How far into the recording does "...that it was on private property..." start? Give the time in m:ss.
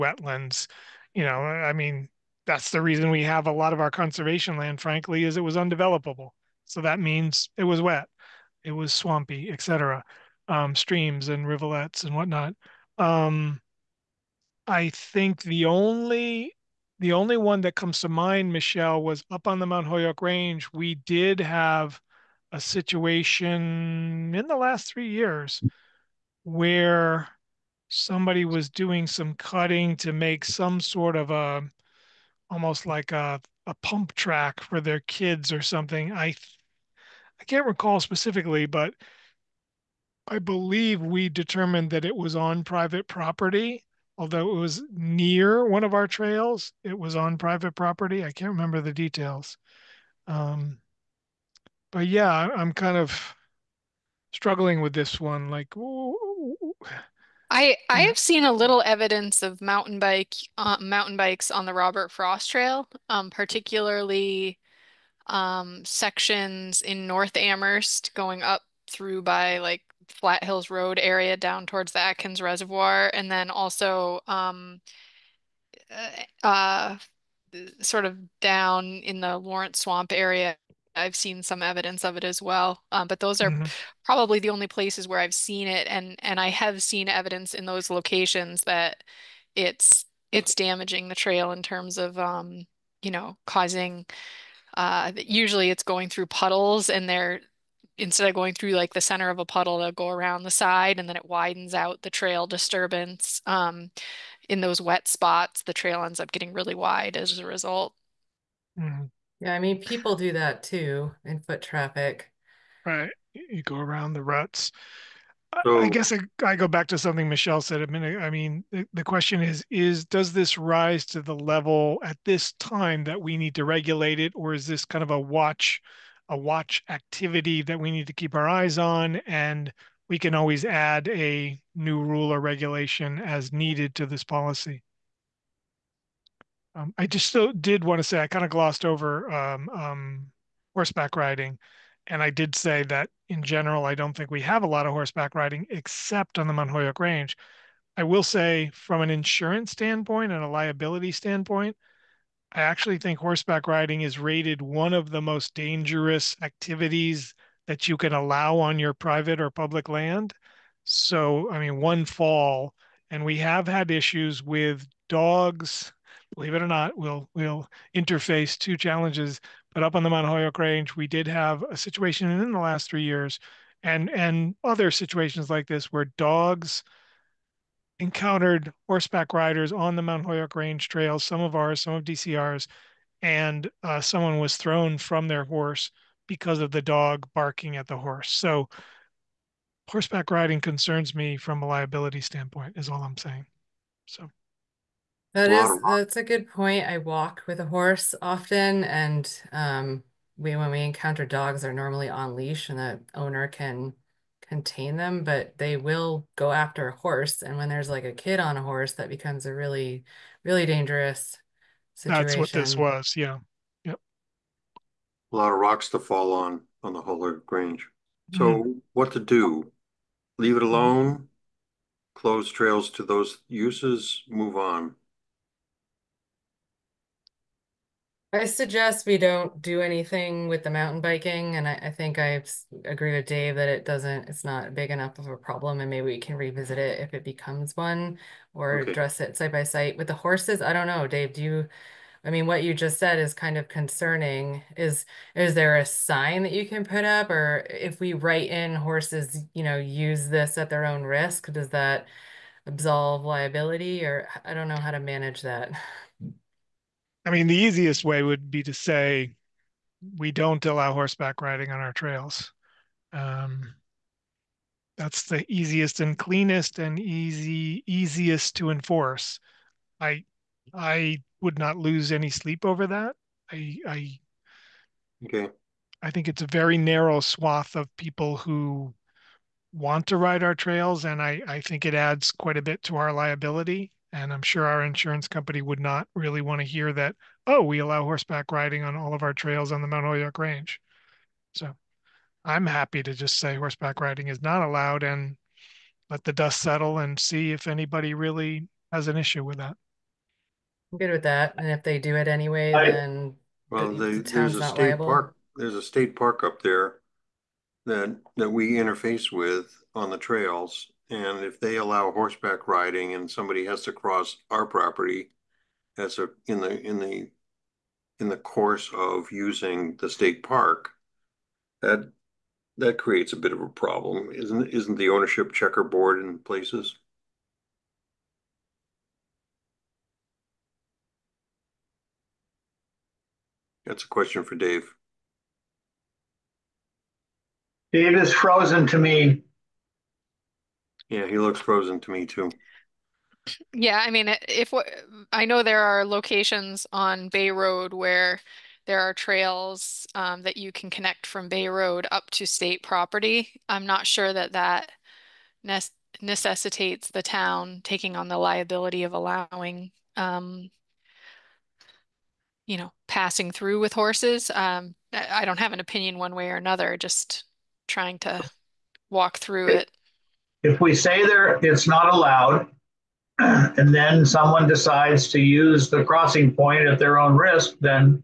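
0:41.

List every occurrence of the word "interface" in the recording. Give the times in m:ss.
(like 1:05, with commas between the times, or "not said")
2:47, 5:08.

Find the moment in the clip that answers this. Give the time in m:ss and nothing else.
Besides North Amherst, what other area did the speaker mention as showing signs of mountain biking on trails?
1:19.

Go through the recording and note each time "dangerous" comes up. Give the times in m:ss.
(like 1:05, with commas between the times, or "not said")
2:35, 3:30.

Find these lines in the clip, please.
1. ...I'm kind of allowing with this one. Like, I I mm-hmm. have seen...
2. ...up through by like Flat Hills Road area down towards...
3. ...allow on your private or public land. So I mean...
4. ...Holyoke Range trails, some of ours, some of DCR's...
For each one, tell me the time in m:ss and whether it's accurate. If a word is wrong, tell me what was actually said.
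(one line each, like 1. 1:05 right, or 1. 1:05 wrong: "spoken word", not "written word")
1. 0:52 wrong: "struggling", not "allowing"
2. 1:08 right
3. 2:38 right
4. 3:00 right.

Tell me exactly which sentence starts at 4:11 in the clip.
Does that absolve liability, or I don't know how to manage that.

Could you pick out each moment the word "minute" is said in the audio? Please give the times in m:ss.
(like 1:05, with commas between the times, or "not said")
1:57.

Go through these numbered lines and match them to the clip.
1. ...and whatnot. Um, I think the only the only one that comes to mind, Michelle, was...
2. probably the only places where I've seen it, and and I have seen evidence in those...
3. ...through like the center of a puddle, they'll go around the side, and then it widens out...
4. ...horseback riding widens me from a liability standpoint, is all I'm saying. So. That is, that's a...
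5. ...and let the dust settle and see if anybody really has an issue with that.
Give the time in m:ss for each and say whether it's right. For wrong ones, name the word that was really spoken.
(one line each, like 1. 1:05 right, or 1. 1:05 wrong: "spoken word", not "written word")
1. 0:12 right
2. 1:24 right
3. 1:38 right
4. 3:09 wrong: "concerns", not "widens"
5. 4:55 right.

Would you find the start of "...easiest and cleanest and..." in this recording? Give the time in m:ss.
4:25.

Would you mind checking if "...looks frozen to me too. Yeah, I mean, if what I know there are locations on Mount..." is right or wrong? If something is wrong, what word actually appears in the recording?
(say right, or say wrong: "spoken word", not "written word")
wrong: "Bay", not "Mount".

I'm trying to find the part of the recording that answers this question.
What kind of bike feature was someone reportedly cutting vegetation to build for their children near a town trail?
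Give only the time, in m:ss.
0:33.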